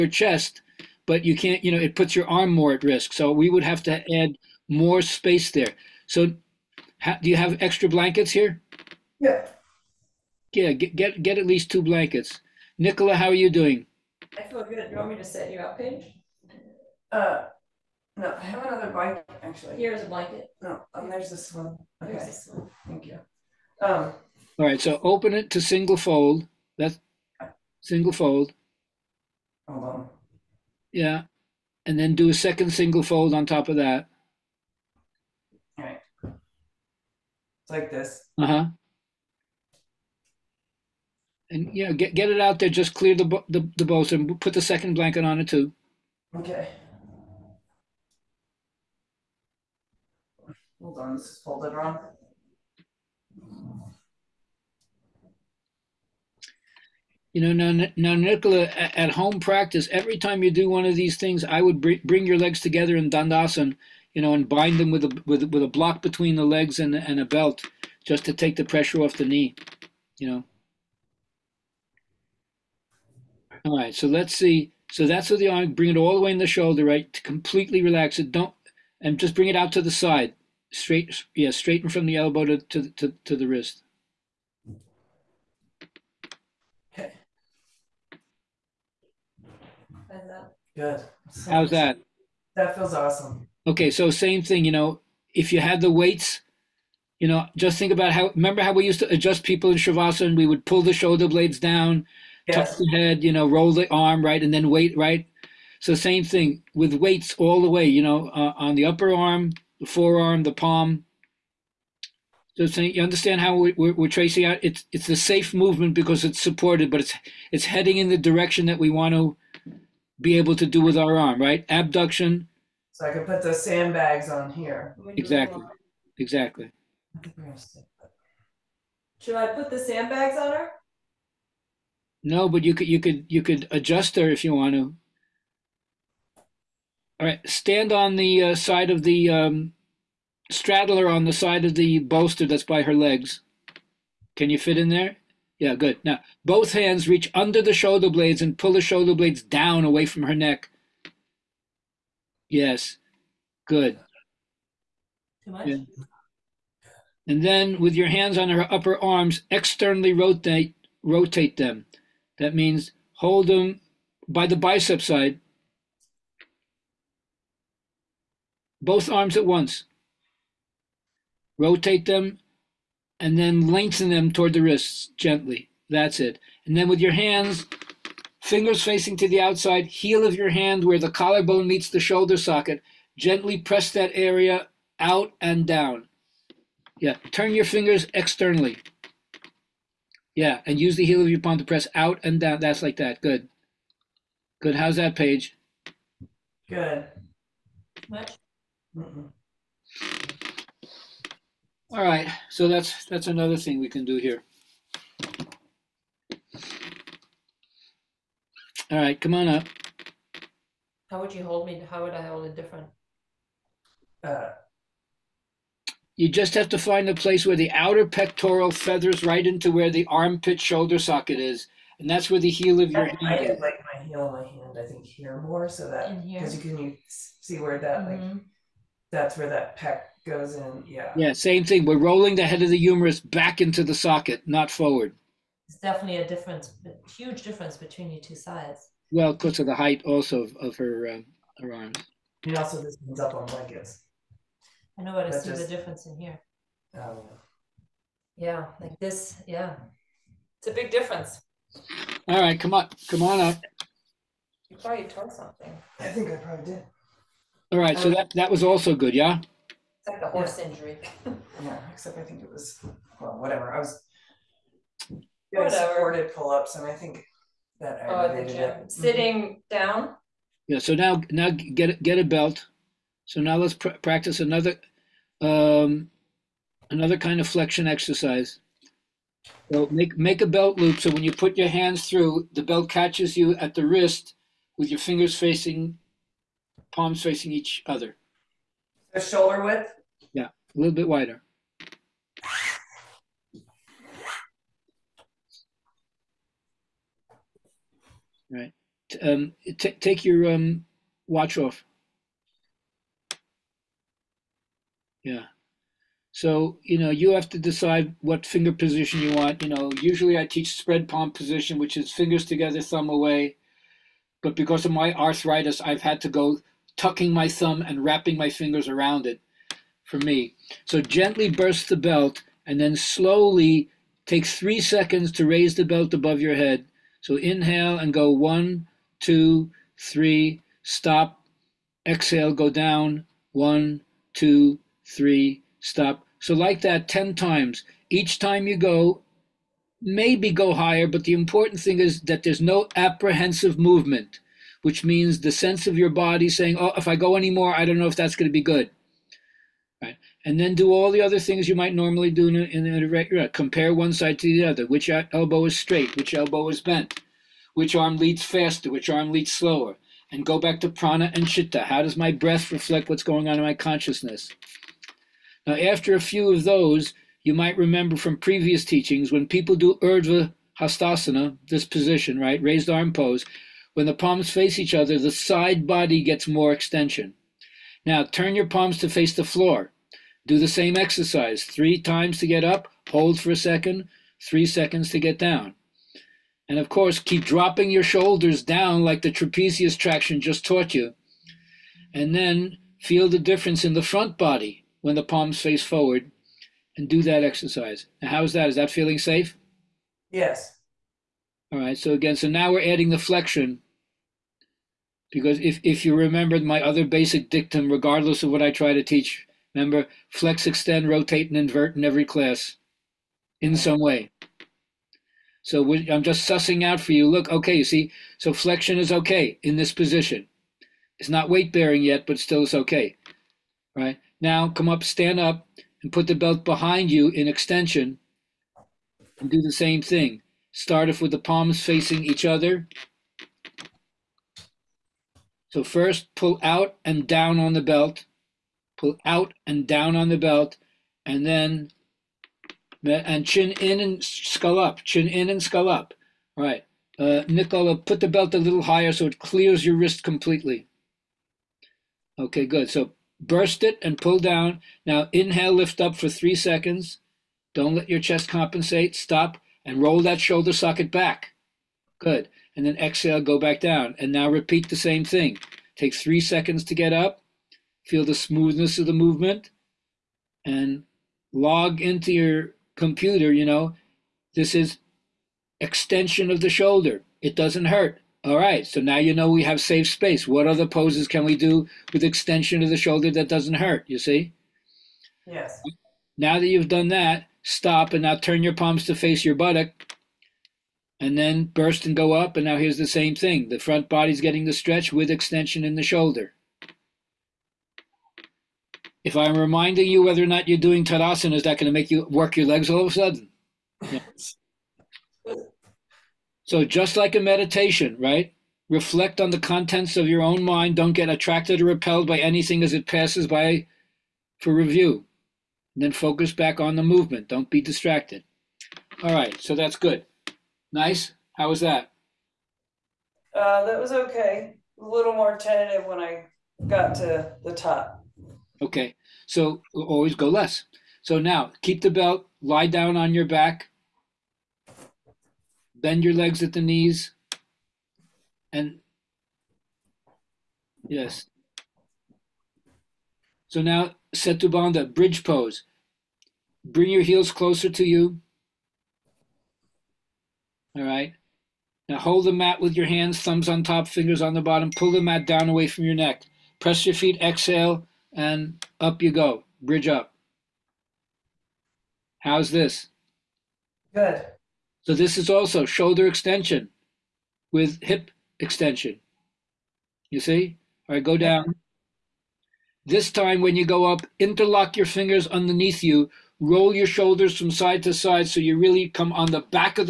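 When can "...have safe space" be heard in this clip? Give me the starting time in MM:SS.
07:59.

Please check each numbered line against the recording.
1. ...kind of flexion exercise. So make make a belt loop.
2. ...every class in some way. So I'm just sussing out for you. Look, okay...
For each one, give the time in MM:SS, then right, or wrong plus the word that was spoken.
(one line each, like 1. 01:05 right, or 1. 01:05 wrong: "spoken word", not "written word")
1. 04:37 right
2. 06:52 right.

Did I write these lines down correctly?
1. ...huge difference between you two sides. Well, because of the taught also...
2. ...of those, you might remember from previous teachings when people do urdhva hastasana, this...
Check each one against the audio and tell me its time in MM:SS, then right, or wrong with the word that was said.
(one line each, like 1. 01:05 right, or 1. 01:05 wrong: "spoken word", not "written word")
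1. 03:57 wrong: "height", not "taught"
2. 06:06 right.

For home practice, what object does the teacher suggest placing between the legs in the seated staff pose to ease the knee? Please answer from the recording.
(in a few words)
A block.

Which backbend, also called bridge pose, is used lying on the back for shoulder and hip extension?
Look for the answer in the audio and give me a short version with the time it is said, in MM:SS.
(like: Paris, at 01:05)
Setubanda, at 09:04.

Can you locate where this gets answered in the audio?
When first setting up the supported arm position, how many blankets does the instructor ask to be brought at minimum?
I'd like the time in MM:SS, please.
00:11.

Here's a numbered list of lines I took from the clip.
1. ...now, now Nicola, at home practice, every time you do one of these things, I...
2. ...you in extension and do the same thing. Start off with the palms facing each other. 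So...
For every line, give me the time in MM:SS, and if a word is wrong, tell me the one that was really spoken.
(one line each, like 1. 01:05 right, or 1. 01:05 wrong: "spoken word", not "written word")
1. 00:57 right
2. 07:07 right.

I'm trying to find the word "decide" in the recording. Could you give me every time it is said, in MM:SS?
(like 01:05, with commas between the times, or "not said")
05:07.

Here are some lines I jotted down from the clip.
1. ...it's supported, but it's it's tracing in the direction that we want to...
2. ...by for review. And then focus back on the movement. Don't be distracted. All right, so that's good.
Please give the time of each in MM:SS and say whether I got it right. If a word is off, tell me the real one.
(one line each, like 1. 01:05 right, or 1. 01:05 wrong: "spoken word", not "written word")
1. 01:56 wrong: "heading", not "tracing"
2. 08:33 right.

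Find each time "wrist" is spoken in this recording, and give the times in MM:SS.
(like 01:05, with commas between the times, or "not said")
01:23, 02:54, 04:43, 07:29.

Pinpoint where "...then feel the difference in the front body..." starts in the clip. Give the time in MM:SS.
06:32.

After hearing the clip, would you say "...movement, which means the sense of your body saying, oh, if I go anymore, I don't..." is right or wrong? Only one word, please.
right.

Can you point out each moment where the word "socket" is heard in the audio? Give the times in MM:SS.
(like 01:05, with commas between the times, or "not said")
03:02, 03:40, 03:53, 07:40.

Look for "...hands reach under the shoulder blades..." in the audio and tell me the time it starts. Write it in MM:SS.
02:26.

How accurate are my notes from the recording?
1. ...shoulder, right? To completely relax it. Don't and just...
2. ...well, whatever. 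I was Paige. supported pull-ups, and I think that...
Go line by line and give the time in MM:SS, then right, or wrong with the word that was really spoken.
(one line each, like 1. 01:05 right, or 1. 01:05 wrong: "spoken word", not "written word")
1. 01:16 right
2. 04:23 wrong: "Whatever", not "Paige".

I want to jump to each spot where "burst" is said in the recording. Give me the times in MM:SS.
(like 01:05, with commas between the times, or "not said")
05:21, 07:33, 08:11.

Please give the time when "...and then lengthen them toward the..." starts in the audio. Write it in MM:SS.
02:53.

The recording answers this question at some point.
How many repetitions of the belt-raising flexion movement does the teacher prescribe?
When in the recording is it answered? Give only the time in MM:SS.
05:37.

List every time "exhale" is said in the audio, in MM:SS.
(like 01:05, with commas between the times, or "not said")
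05:32, 07:42, 09:17.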